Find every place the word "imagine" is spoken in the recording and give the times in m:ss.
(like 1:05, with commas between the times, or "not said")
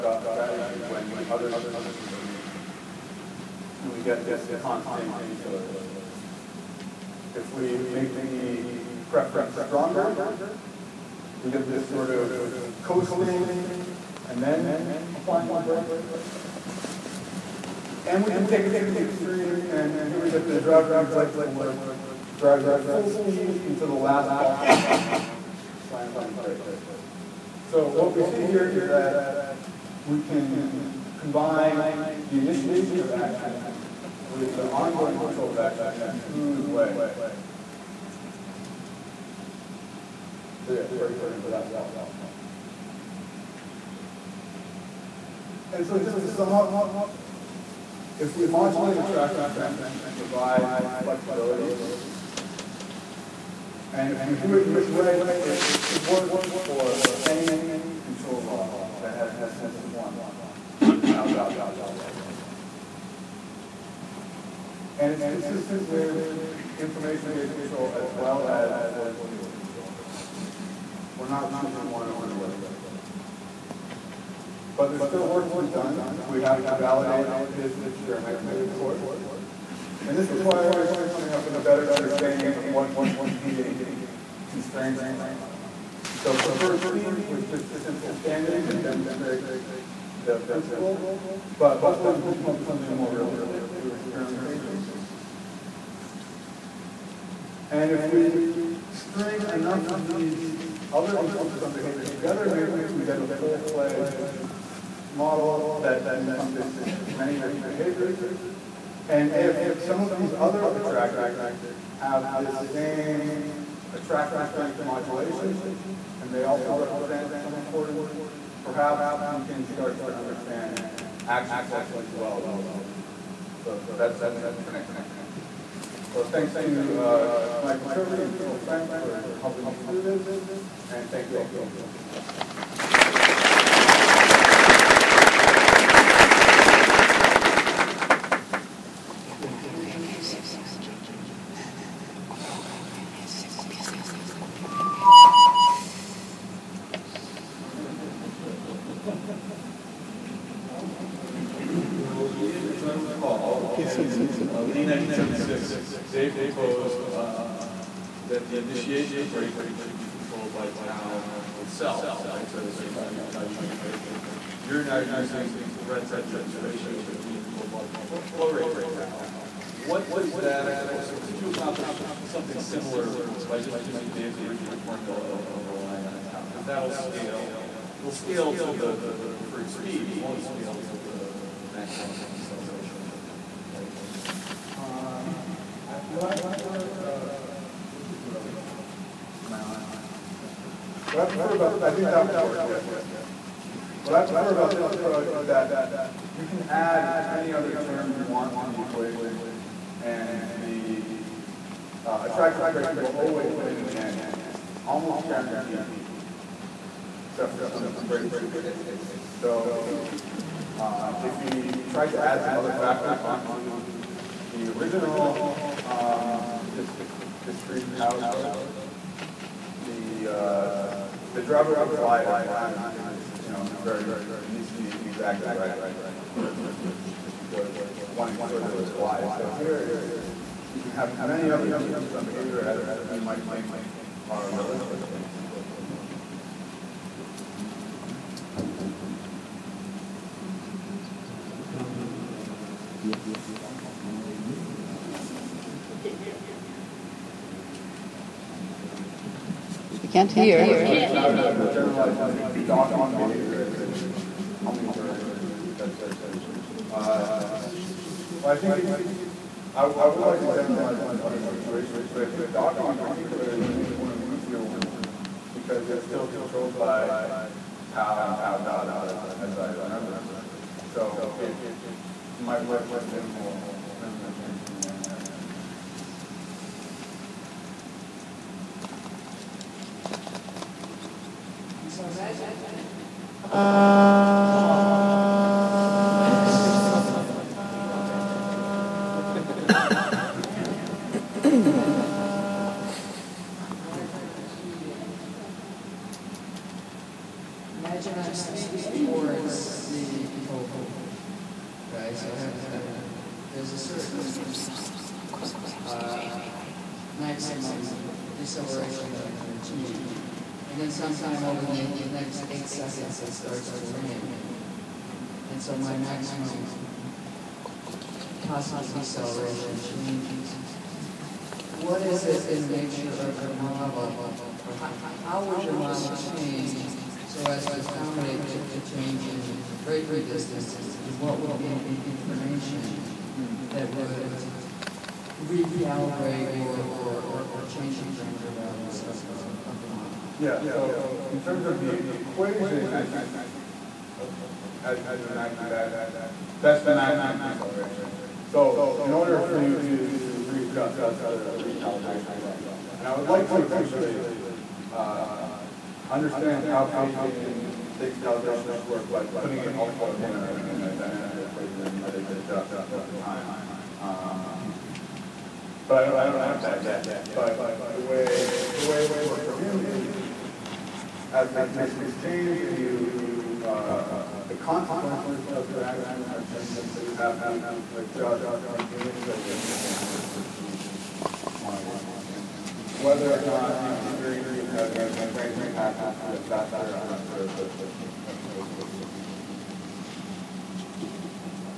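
4:57, 5:45.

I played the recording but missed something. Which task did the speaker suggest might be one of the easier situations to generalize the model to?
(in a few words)
docking.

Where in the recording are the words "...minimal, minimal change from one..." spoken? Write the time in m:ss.
4:33.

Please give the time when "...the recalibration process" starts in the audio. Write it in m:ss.
5:51.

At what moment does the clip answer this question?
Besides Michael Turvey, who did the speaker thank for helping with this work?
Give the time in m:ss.
2:08.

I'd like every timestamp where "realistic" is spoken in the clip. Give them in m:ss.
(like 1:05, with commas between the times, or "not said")
1:33, 3:54.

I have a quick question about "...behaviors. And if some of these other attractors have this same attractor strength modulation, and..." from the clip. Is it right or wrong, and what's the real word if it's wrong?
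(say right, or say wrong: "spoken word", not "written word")
right.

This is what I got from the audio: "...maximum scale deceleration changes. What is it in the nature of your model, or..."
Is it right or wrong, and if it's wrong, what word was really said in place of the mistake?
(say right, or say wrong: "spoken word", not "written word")
wrong: "possible", not "scale".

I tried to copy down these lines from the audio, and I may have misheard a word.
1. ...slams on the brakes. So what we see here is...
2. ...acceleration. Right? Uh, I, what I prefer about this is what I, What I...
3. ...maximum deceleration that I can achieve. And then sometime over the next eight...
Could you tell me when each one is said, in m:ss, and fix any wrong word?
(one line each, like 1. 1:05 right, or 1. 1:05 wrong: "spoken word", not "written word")
1. 0:25 right
2. 3:02 right
3. 5:07 right.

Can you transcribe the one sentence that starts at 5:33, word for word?
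that would recalibrate or, or, or, or change the parameter values of, of, the model.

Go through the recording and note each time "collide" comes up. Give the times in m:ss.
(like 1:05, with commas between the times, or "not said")
3:41, 3:48.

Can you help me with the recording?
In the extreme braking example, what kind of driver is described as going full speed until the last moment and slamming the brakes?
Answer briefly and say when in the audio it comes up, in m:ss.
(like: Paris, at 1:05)
late for work, at 0:21.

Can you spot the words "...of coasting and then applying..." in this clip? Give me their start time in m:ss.
0:12.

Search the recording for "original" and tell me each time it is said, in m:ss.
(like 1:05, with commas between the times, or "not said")
2:54, 3:34.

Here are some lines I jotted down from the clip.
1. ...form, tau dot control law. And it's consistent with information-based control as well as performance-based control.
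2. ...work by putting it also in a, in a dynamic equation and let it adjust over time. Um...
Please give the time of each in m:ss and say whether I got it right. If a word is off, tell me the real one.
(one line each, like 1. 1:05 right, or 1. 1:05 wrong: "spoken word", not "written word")
1. 0:59 right
2. 5:58 right.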